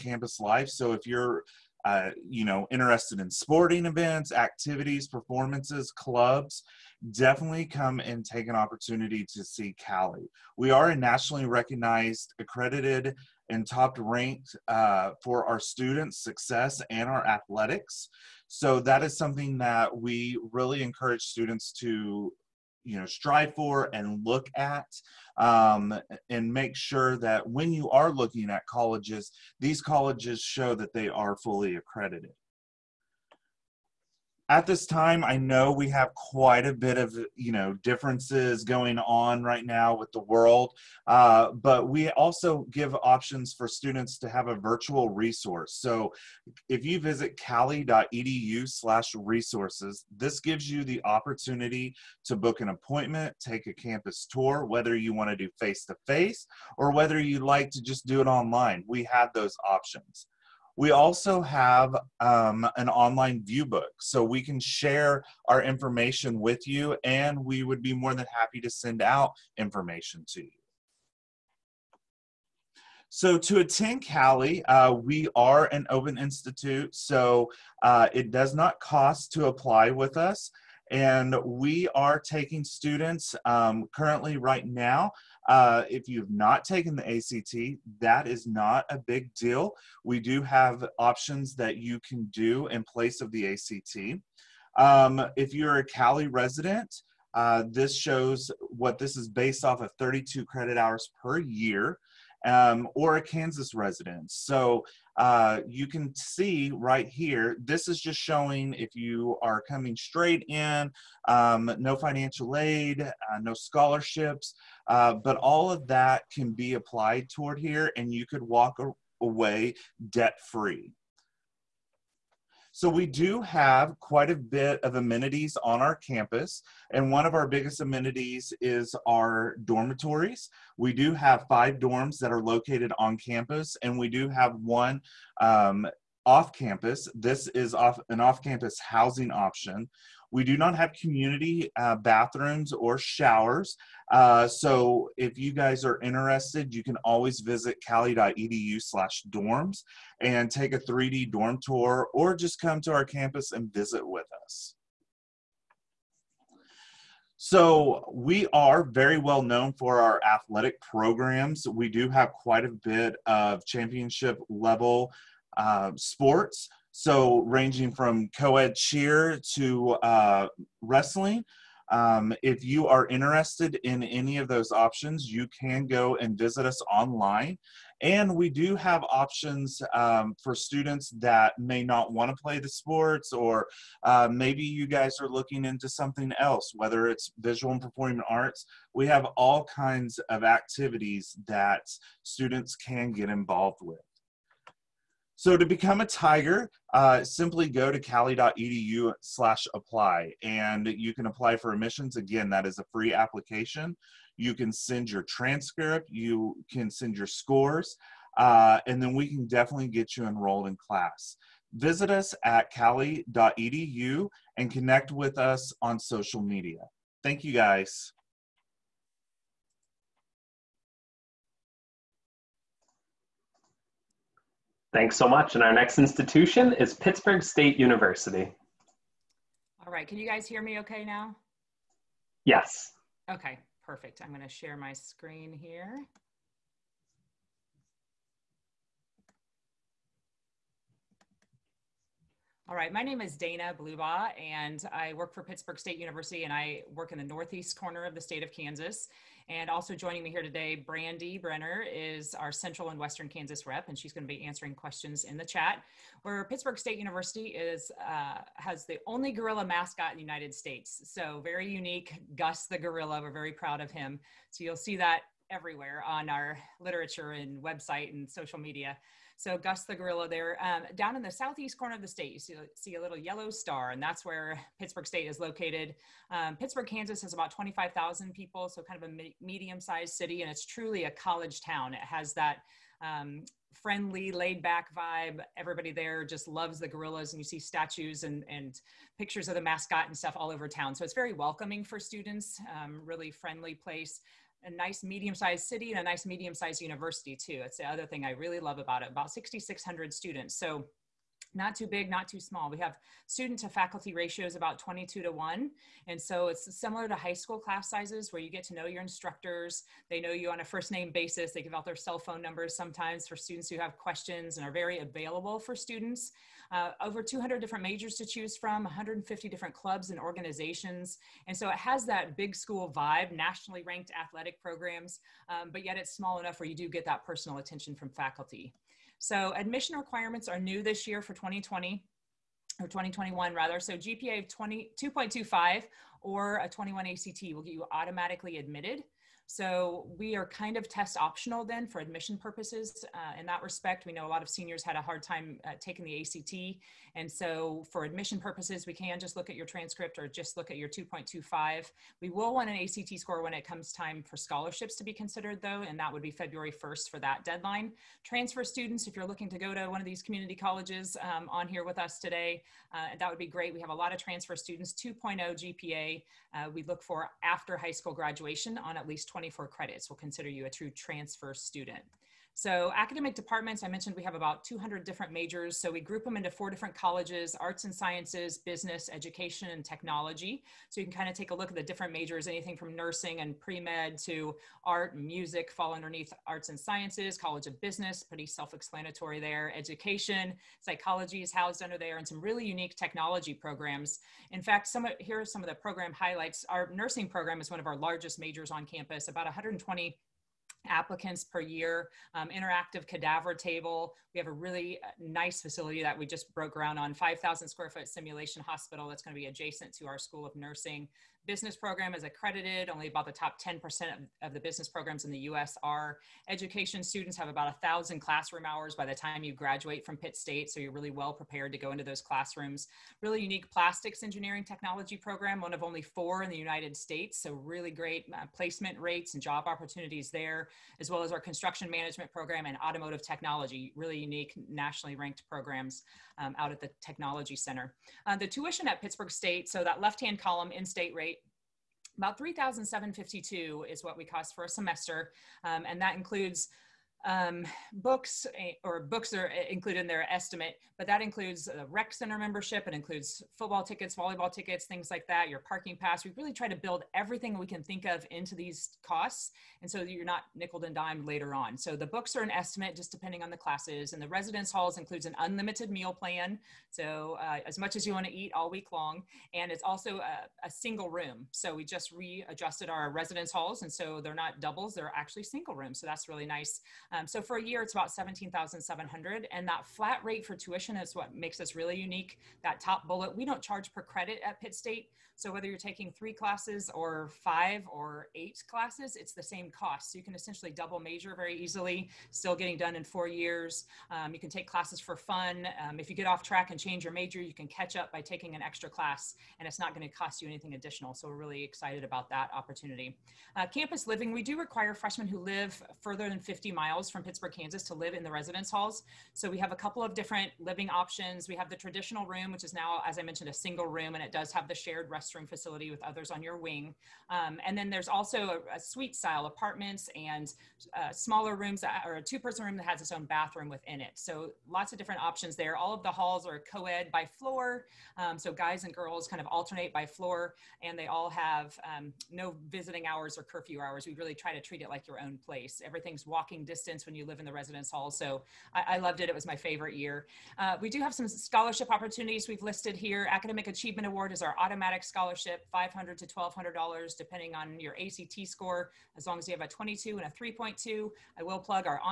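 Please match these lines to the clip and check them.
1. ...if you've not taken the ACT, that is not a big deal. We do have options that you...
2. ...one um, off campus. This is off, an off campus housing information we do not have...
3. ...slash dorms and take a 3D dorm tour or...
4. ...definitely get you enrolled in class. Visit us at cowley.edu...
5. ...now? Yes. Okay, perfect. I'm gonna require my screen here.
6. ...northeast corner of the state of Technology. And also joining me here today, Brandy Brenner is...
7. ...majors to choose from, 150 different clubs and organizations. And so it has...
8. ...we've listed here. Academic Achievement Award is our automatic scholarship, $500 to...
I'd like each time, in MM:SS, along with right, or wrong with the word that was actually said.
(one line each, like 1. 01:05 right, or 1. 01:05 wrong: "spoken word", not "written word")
1. 01:25 right
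2. 02:14 wrong: "option", not "information"
3. 02:28 right
4. 03:29 right
5. 03:51 wrong: "share", not "require"
6. 04:07 wrong: "Kansas", not "Technology"
7. 05:17 right
8. 09:02 right.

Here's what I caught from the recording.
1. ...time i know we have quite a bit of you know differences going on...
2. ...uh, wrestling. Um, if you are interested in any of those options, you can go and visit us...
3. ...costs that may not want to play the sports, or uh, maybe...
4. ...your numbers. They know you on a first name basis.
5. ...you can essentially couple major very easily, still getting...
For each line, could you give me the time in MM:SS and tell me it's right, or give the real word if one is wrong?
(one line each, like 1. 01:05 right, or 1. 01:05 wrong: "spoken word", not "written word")
1. 00:34 right
2. 02:50 right
3. 03:00 wrong: "students", not "costs"
4. 05:08 wrong: "instructors", not "numbers"
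5. 08:10 wrong: "double", not "couple".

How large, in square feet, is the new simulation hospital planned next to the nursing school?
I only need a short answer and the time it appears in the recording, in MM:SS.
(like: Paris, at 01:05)
5,000 square feet, at 06:47.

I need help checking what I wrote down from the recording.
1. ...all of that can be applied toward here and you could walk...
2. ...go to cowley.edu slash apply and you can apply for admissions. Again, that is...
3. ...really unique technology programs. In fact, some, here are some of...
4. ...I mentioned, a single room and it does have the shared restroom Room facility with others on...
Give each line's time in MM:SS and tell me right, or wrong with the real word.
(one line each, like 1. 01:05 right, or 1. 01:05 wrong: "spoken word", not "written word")
1. 01:55 right
2. 03:17 right
3. 06:32 right
4. 08:33 right.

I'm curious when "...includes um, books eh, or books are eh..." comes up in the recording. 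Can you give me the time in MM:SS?
07:26.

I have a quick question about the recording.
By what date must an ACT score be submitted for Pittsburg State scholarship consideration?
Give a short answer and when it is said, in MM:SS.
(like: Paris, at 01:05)
February 1st, at 05:56.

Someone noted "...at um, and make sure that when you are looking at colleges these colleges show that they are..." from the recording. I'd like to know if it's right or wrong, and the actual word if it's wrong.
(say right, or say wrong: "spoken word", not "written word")
right.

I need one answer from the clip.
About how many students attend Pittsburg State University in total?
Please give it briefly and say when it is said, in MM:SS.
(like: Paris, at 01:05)
6,600, at 04:59.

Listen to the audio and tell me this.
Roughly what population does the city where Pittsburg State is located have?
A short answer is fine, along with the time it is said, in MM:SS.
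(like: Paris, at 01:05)
25,000, at 04:37.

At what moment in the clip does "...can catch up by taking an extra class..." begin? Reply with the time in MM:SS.
08:17.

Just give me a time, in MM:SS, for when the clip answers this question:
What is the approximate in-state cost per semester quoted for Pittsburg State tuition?
07:22.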